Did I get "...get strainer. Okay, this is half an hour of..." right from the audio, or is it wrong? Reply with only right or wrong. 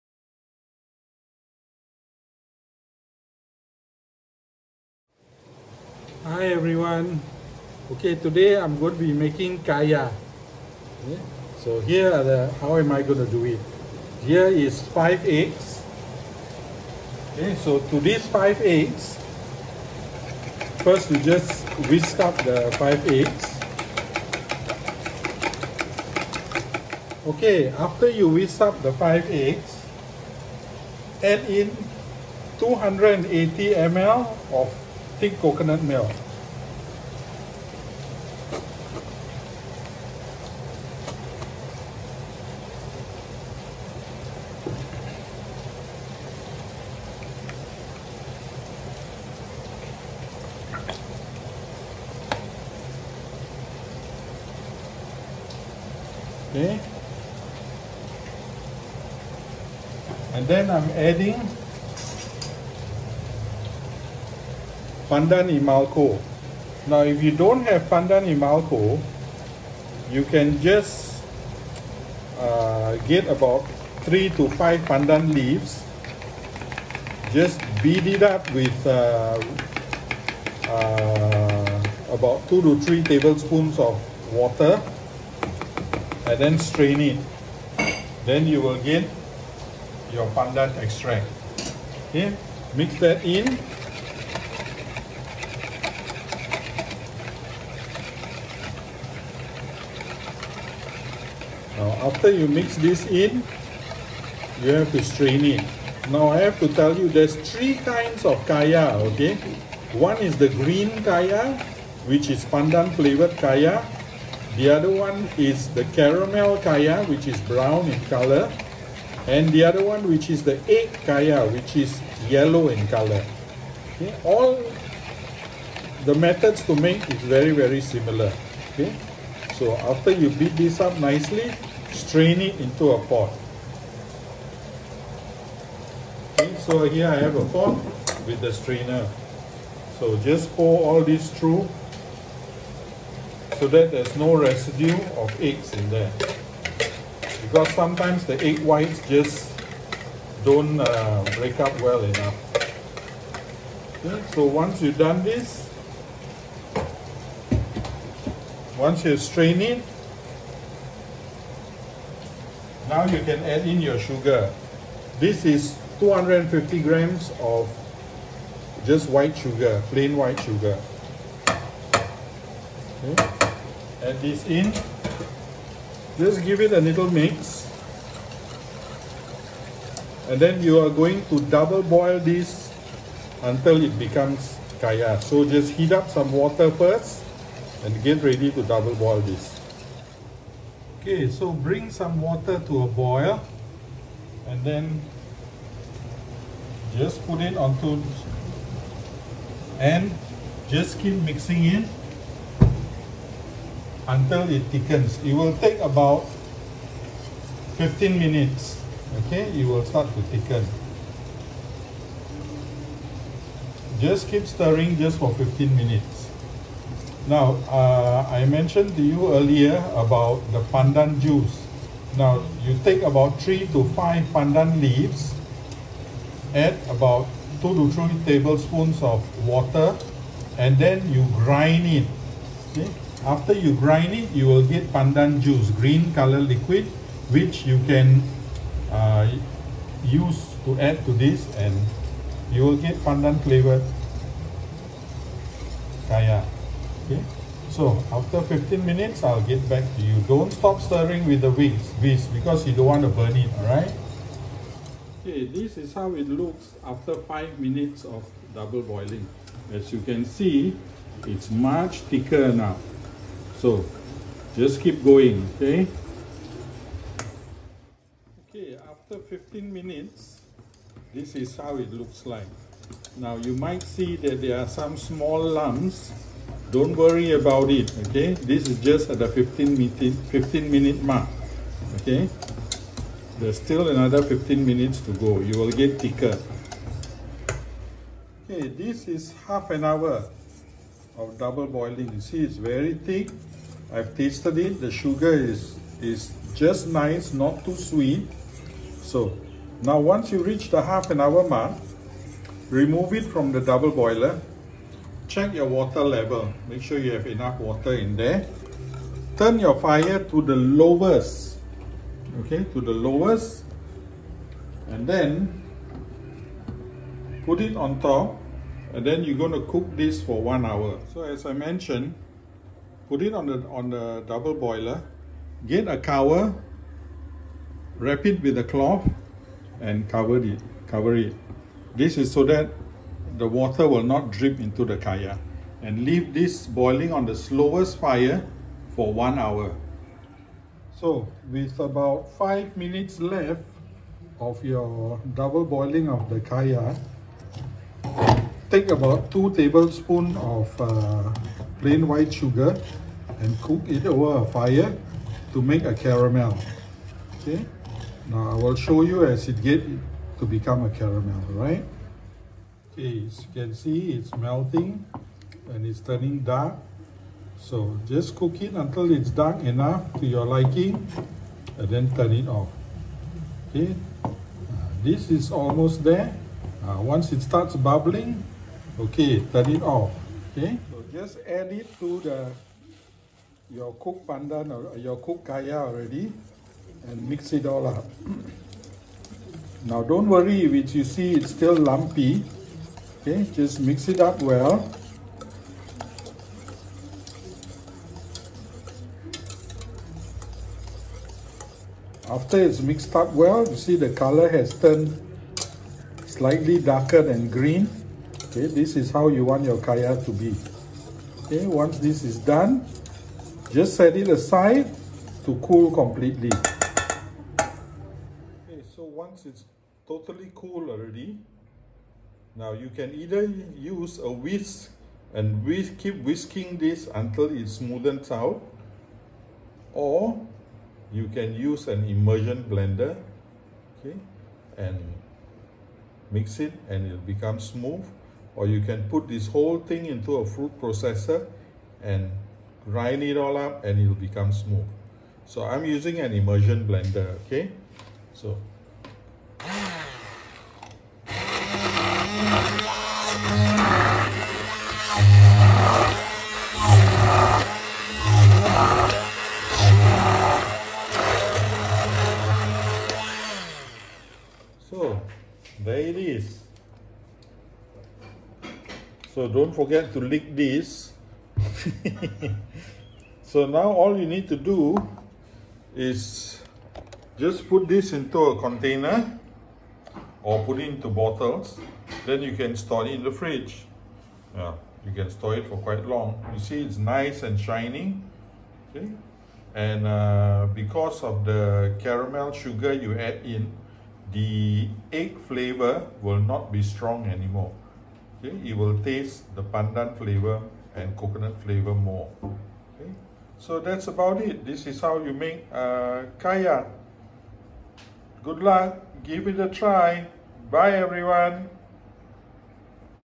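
wrong.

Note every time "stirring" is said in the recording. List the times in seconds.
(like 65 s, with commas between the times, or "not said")
214 s, 250 s.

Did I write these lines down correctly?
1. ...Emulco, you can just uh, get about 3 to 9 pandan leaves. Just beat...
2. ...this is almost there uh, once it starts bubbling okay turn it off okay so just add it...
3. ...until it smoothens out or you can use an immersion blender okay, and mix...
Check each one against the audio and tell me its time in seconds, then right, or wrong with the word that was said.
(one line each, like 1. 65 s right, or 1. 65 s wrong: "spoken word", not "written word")
1. 68 s wrong: "5", not "9"
2. 375 s right
3. 427 s right.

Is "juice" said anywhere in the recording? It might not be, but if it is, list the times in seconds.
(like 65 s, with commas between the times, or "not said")
221 s, 235 s.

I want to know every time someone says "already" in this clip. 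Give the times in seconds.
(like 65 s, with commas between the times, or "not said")
385 s, 420 s.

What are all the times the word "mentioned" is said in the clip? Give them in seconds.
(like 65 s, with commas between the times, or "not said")
218 s, 321 s.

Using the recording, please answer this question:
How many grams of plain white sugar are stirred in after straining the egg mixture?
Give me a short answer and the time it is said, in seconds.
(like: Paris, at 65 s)
250 grams, at 165 s.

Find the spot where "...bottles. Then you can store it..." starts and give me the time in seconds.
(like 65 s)
481 s.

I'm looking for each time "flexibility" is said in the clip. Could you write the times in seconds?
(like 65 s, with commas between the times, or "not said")
not said.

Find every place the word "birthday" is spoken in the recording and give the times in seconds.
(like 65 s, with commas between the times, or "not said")
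not said.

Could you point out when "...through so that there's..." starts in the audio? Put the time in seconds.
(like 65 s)
141 s.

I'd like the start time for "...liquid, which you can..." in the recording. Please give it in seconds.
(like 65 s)
236 s.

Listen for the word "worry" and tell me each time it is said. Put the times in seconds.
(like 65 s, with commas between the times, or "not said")
276 s, 390 s.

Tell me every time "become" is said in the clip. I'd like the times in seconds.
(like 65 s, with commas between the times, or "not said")
183 s, 360 s, 437 s, 444 s.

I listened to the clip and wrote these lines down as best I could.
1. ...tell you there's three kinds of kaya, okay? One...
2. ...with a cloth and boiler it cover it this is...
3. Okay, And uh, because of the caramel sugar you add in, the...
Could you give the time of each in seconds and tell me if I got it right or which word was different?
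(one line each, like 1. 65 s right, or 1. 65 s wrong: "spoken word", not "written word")
1. 106 s right
2. 328 s wrong: "cover", not "boiler"
3. 488 s right.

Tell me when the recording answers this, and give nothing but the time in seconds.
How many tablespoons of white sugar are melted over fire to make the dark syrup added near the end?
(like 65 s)
349 s.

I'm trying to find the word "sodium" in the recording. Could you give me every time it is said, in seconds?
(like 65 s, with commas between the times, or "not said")
not said.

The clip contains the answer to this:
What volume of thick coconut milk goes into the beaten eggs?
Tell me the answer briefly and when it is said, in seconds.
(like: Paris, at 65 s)
280 ml, at 32 s.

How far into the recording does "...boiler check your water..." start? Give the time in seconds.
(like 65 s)
303 s.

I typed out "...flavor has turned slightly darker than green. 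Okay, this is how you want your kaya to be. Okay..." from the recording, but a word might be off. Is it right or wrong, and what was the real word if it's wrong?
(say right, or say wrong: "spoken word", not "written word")
wrong: "color", not "flavor".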